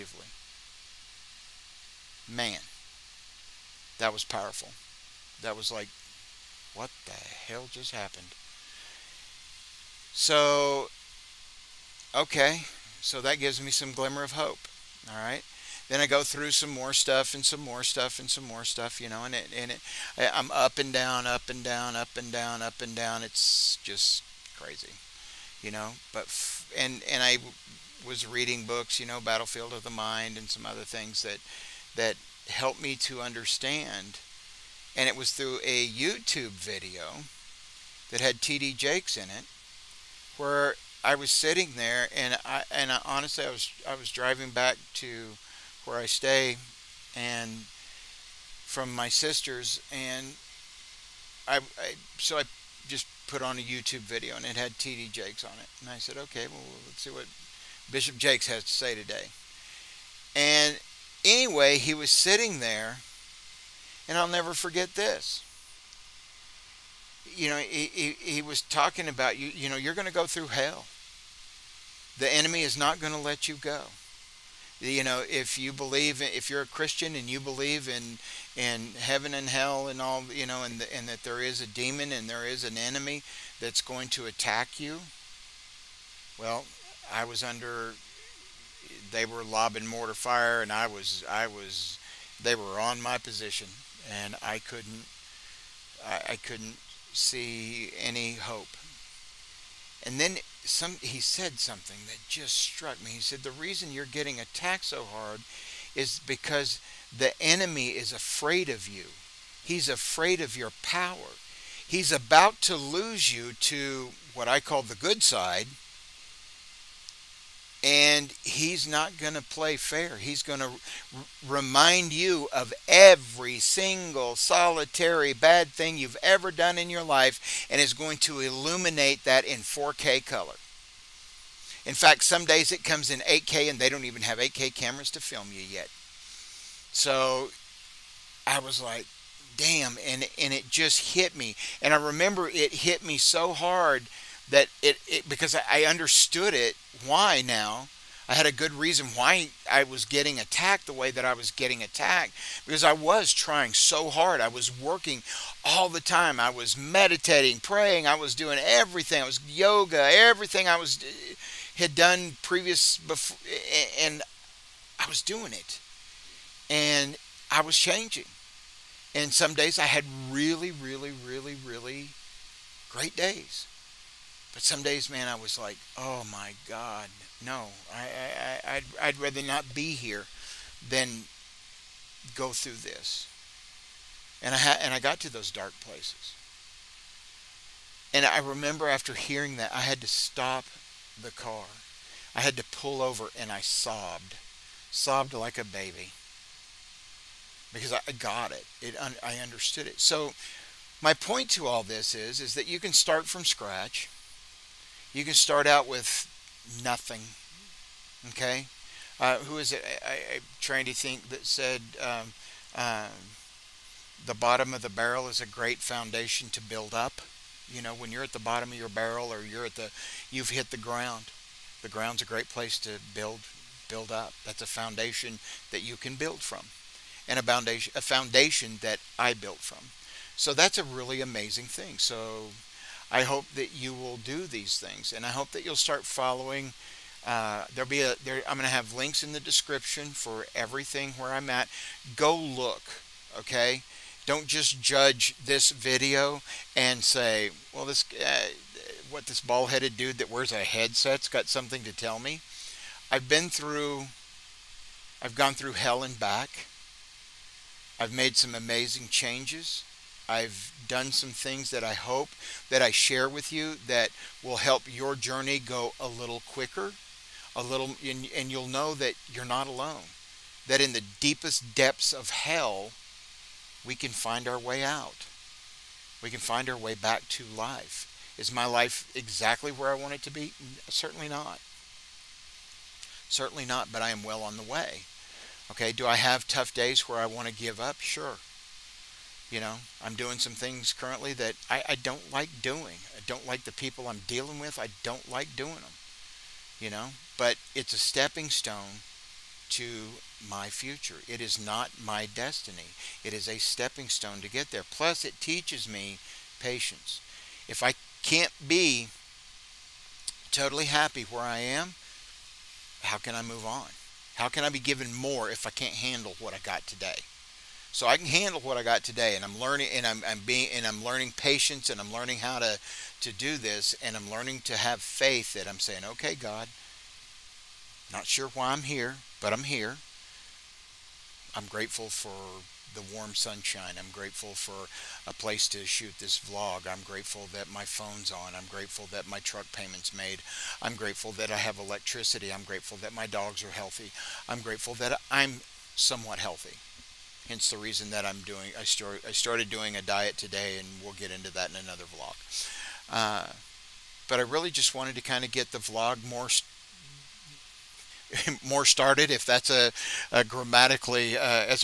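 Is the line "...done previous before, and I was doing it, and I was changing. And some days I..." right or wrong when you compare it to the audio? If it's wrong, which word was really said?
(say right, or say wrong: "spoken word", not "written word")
right.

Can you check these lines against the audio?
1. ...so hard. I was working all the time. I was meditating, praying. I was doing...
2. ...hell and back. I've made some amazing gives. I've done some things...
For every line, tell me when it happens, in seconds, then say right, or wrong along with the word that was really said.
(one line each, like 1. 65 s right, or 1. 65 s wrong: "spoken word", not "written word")
1. 153 s right
2. 255 s wrong: "changes", not "gives".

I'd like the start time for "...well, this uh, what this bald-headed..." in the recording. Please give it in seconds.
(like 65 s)
247 s.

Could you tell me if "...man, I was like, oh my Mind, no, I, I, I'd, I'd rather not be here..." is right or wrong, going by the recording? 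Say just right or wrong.
wrong.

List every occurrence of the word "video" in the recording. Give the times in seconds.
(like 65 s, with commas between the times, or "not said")
36 s, 53 s, 245 s.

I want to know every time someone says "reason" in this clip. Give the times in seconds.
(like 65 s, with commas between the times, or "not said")
103 s, 148 s, 347 s.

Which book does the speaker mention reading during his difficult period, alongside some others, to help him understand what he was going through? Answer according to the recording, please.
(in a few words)
Battlefield of the Mind.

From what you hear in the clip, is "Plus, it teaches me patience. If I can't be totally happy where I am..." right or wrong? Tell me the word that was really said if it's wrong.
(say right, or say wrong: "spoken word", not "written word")
right.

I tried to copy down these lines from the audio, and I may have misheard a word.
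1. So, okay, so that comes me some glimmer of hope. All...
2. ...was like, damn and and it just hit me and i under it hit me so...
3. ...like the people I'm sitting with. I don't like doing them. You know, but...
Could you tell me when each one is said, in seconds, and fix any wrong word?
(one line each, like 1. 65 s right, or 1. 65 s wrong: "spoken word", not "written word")
1. 10 s wrong: "gives", not "comes"
2. 138 s wrong: "remember", not "under"
3. 293 s wrong: "dealing", not "sitting".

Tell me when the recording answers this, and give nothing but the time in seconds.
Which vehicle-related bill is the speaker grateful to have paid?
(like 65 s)
339 s.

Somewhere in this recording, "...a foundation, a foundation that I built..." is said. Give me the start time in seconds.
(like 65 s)
227 s.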